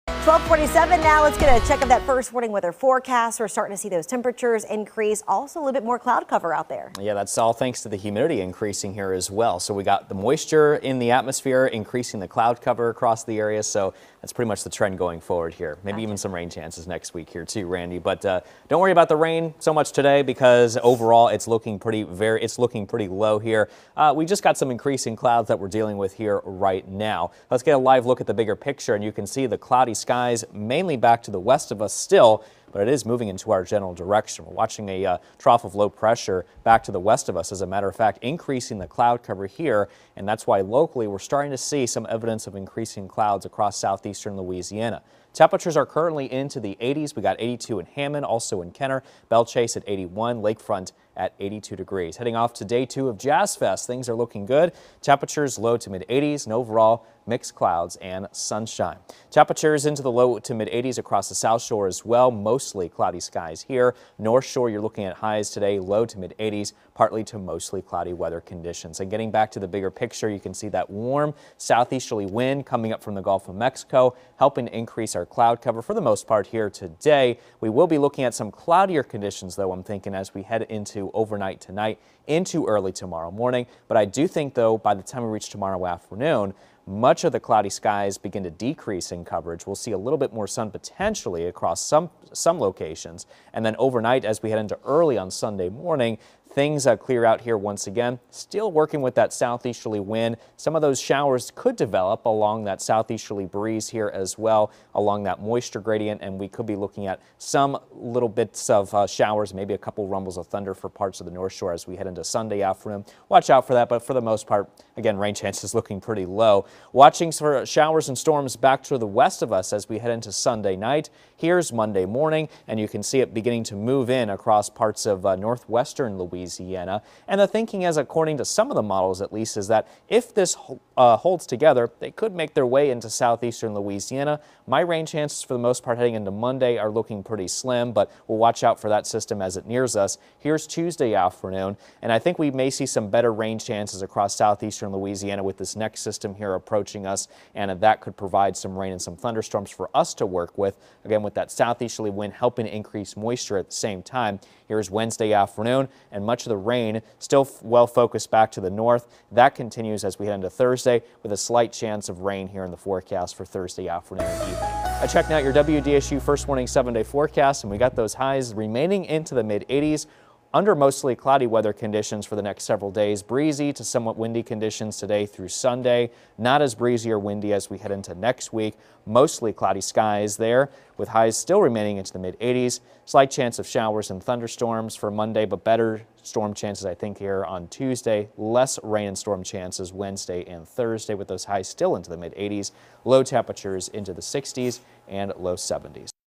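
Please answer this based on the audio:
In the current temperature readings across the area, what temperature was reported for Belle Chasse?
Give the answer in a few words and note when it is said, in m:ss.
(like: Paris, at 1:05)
81, at 0:49.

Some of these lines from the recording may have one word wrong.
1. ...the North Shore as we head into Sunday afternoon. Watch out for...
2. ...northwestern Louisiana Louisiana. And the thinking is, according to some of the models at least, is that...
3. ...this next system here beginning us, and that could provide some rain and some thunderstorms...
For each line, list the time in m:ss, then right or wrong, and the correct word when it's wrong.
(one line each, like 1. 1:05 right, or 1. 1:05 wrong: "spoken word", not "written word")
1. 1:51 right
2. 2:05 right
3. 2:25 wrong: "approaching", not "beginning".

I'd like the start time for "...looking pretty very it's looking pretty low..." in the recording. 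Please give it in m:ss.
0:21.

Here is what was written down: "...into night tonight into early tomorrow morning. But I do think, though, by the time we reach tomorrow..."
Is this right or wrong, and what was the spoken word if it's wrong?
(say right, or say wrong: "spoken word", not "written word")
wrong: "overnight", not "night".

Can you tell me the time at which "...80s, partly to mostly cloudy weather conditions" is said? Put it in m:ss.
1:06.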